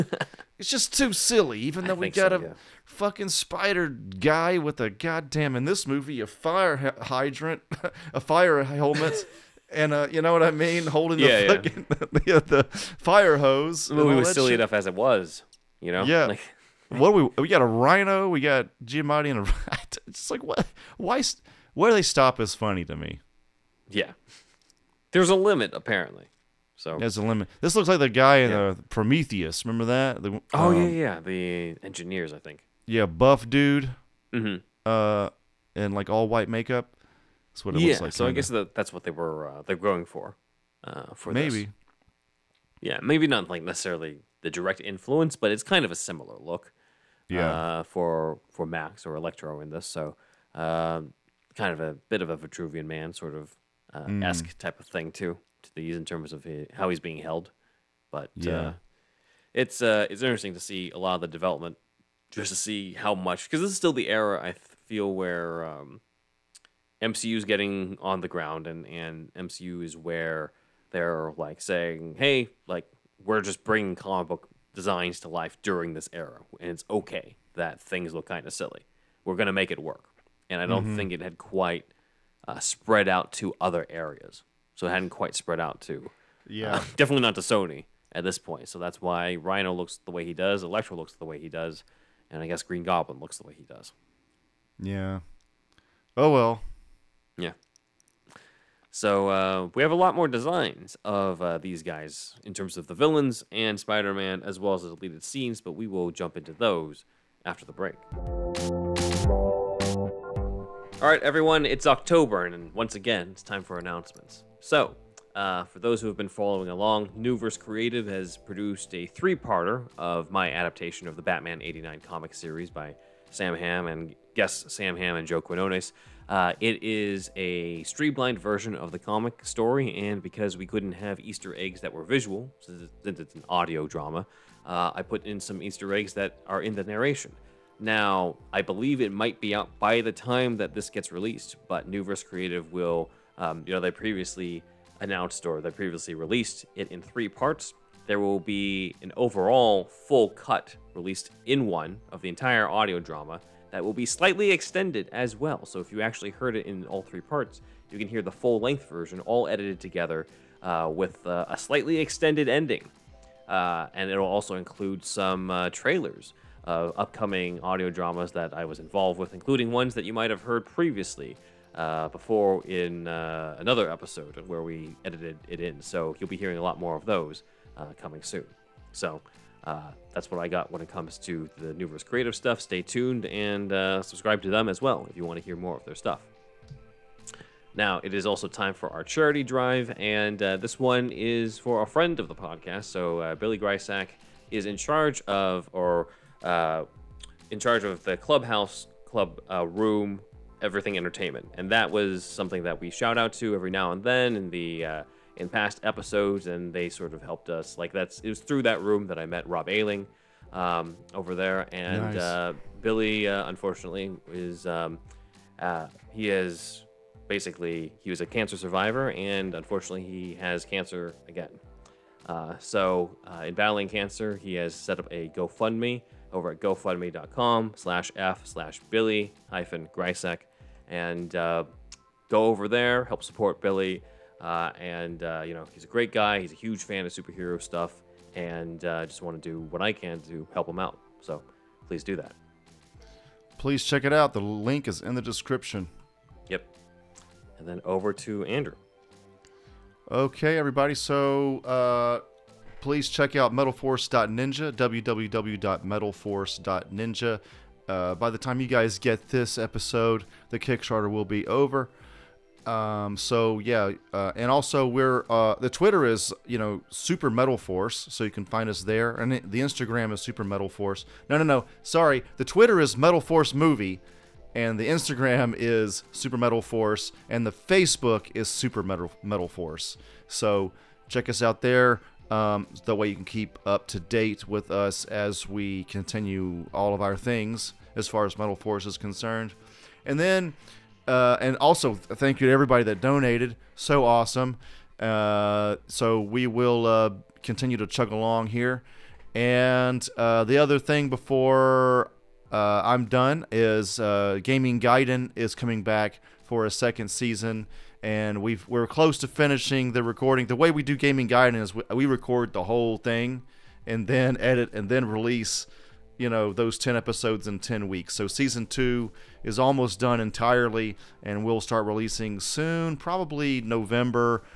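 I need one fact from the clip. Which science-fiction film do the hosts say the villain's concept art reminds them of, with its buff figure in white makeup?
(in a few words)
Prometheus.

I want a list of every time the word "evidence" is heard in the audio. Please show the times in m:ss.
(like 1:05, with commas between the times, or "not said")
not said.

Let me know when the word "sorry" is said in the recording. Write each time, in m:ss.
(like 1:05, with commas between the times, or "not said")
4:31.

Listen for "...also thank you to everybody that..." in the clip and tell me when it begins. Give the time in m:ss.
4:51.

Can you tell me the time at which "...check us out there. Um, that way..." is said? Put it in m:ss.
4:41.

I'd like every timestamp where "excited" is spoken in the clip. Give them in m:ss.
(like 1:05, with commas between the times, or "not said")
not said.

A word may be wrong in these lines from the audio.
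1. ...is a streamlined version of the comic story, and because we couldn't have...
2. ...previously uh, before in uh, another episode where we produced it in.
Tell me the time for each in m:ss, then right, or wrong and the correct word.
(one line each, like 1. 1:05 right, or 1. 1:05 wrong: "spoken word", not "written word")
1. 2:06 right
2. 2:50 wrong: "edited", not "produced".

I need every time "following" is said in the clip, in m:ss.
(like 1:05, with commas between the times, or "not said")
1:56.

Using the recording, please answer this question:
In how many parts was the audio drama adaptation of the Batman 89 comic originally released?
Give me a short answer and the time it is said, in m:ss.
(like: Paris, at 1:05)
3, at 1:59.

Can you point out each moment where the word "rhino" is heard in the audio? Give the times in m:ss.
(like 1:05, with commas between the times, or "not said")
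0:17, 1:29.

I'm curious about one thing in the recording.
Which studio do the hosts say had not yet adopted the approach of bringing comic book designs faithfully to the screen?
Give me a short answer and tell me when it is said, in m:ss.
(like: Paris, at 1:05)
Sony, at 1:27.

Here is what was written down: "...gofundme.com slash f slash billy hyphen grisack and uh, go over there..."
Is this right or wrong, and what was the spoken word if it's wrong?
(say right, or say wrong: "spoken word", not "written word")
right.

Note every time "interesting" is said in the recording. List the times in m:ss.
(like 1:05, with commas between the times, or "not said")
1:00.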